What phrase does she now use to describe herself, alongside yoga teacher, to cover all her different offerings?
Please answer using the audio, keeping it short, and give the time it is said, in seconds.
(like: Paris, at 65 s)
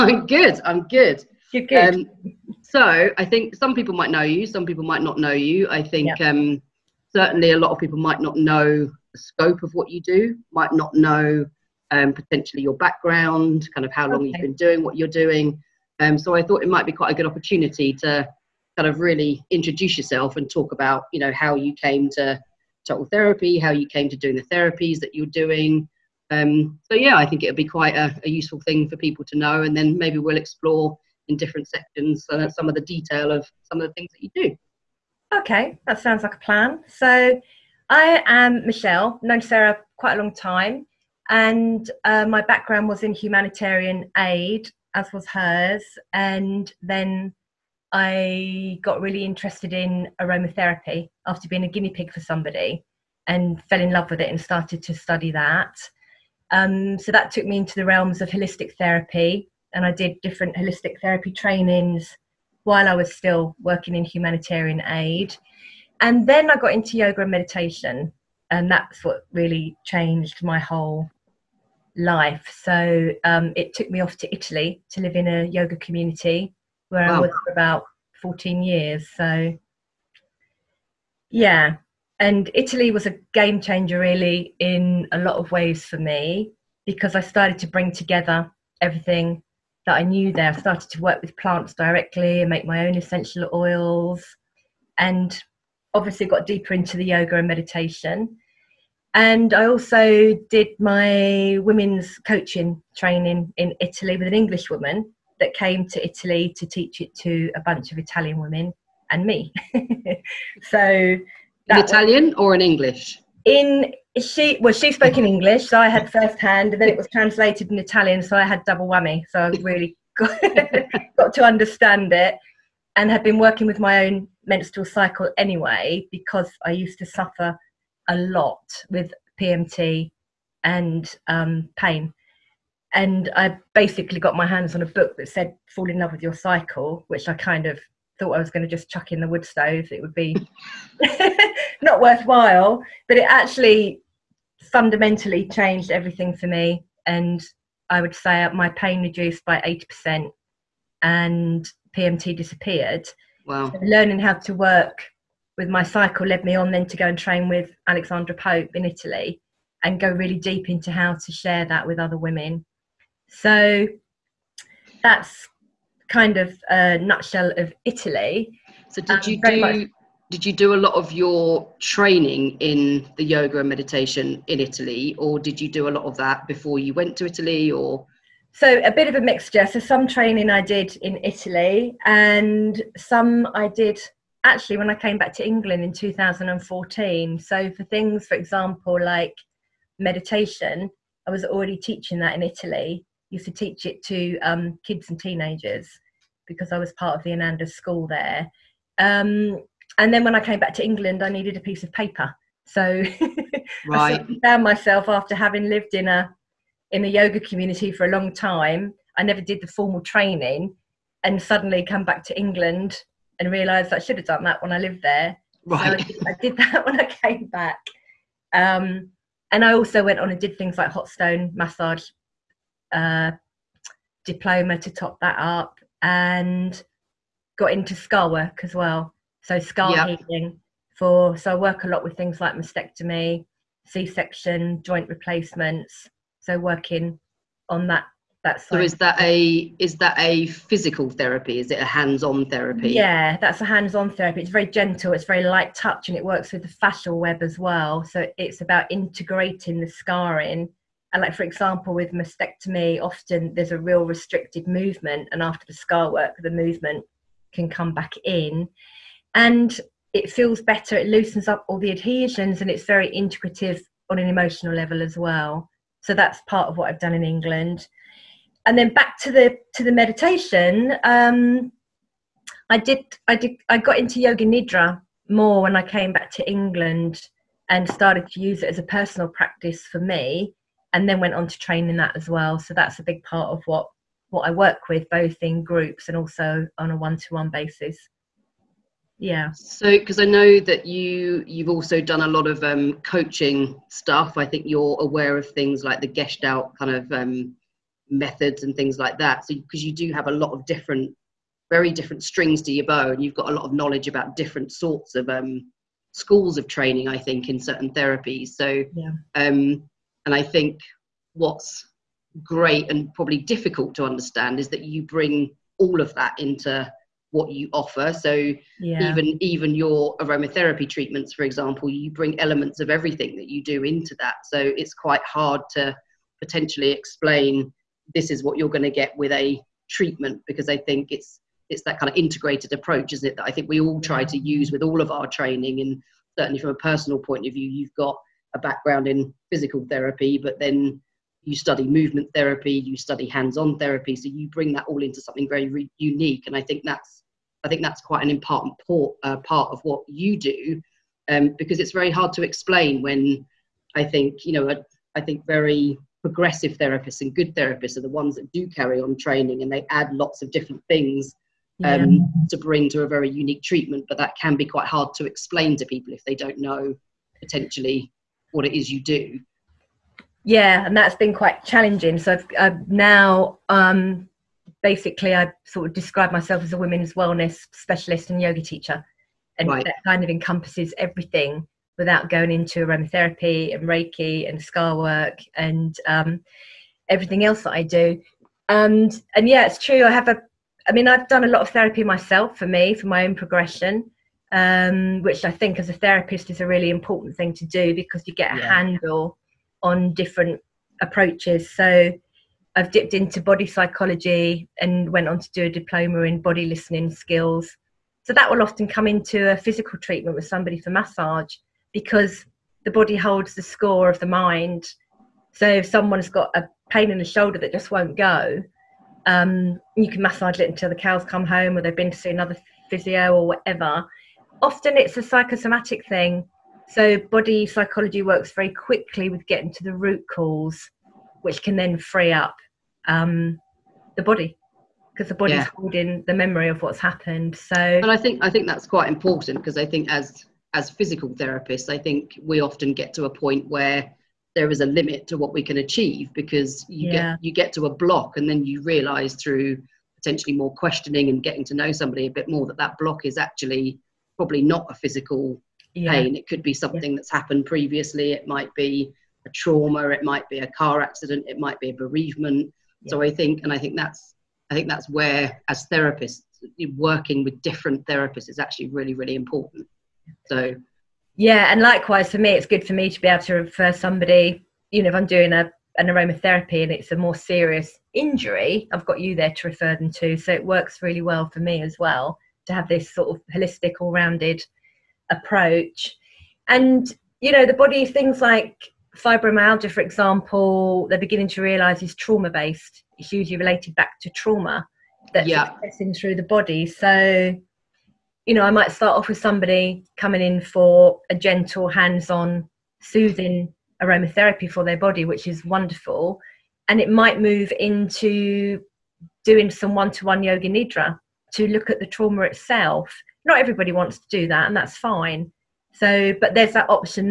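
Women's wellness specialist, at 376 s.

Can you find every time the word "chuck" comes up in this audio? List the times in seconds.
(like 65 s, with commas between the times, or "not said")
138 s.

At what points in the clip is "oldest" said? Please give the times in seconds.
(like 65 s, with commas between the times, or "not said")
not said.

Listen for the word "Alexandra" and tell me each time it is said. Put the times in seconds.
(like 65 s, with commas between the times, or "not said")
157 s.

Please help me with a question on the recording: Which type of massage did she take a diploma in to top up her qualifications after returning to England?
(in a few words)
Hot stone massage.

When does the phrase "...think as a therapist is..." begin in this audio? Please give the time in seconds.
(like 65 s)
395 s.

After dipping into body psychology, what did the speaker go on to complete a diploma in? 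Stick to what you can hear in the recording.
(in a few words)
Body listening skills.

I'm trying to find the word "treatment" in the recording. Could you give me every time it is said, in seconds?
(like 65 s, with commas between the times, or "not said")
320 s, 329 s, 363 s, 409 s.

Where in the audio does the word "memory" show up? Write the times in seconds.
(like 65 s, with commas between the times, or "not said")
436 s.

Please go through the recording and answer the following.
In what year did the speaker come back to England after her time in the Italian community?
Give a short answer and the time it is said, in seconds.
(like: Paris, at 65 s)
2014, at 185 s.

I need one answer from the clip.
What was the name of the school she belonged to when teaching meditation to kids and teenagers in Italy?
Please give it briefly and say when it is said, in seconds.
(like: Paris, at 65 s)
Ananda school, at 197 s.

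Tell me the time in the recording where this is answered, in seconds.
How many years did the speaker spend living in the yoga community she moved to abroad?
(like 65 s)
78 s.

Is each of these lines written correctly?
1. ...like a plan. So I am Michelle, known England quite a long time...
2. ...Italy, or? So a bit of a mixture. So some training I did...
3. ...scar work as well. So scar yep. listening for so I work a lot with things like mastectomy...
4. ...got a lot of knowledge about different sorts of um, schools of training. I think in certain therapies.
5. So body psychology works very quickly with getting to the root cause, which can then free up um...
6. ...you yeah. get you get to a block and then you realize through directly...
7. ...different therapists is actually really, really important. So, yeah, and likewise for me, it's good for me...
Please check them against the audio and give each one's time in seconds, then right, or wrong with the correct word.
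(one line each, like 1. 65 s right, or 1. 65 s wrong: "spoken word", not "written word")
1. 36 s wrong: "Sarah", not "England"
2. 177 s right
3. 227 s wrong: "healing", not "listening"
4. 303 s right
5. 426 s right
6. 446 s wrong: "potentially", not "directly"
7. 467 s right.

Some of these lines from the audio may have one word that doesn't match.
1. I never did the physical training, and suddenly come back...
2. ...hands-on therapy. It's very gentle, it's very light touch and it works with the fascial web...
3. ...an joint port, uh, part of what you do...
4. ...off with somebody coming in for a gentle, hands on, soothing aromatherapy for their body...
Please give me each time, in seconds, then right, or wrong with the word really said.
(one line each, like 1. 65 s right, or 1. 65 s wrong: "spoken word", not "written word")
1. 209 s wrong: "formal", not "physical"
2. 243 s right
3. 348 s wrong: "important", not "joint"
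4. 499 s right.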